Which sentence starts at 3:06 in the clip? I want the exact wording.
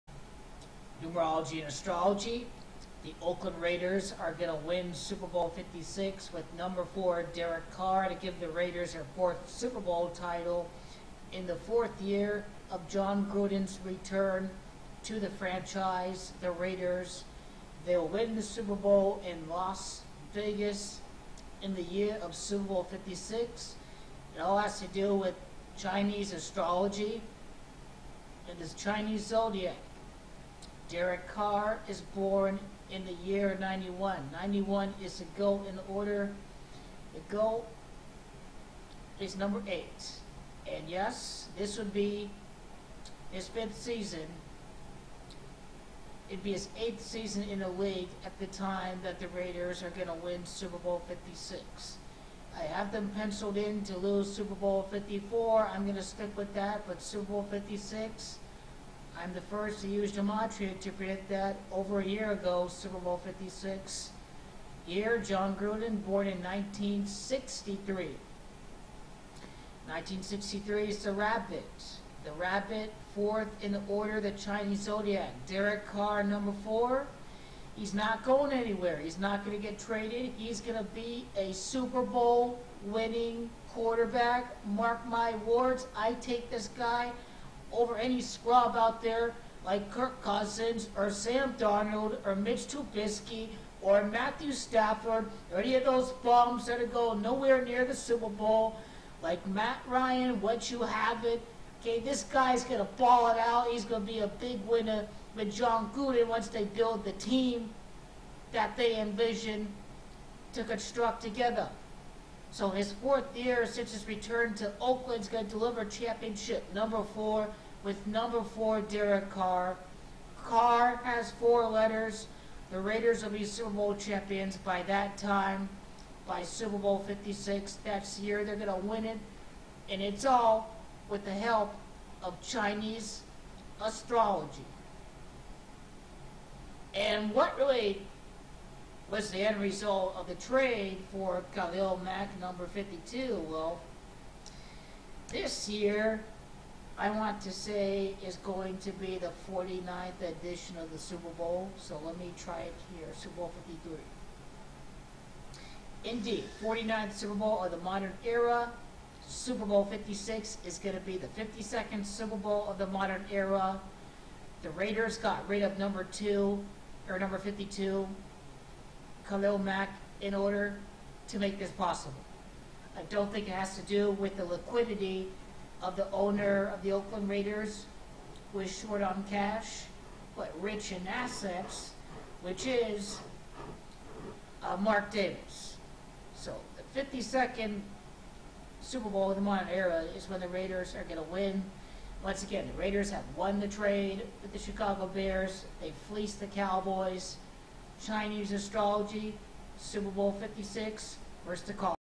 So the 52nd Super Bowl of the modern era is when the Raiders are going to win.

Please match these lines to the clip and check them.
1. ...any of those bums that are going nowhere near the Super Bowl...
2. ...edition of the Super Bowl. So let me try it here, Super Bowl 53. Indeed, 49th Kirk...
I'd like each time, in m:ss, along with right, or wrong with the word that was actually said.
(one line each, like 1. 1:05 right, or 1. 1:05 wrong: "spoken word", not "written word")
1. 1:35 right
2. 2:30 wrong: "Super", not "Kirk".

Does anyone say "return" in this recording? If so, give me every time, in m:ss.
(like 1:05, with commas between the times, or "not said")
0:13, 1:54.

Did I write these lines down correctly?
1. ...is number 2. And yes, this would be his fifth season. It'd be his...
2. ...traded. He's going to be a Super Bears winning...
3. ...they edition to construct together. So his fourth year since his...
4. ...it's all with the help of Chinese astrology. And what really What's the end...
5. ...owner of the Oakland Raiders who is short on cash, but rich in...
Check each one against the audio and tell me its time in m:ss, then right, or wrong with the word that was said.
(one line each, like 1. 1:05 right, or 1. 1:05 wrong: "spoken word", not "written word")
1. 0:39 wrong: "8", not "2"
2. 1:19 wrong: "Bowl", not "Bears"
3. 1:48 wrong: "envision", not "edition"
4. 2:10 right
5. 2:56 right.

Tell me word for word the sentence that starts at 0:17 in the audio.
They'll win the Super Bowl in Las Vegas in the year of Super Bowl 56.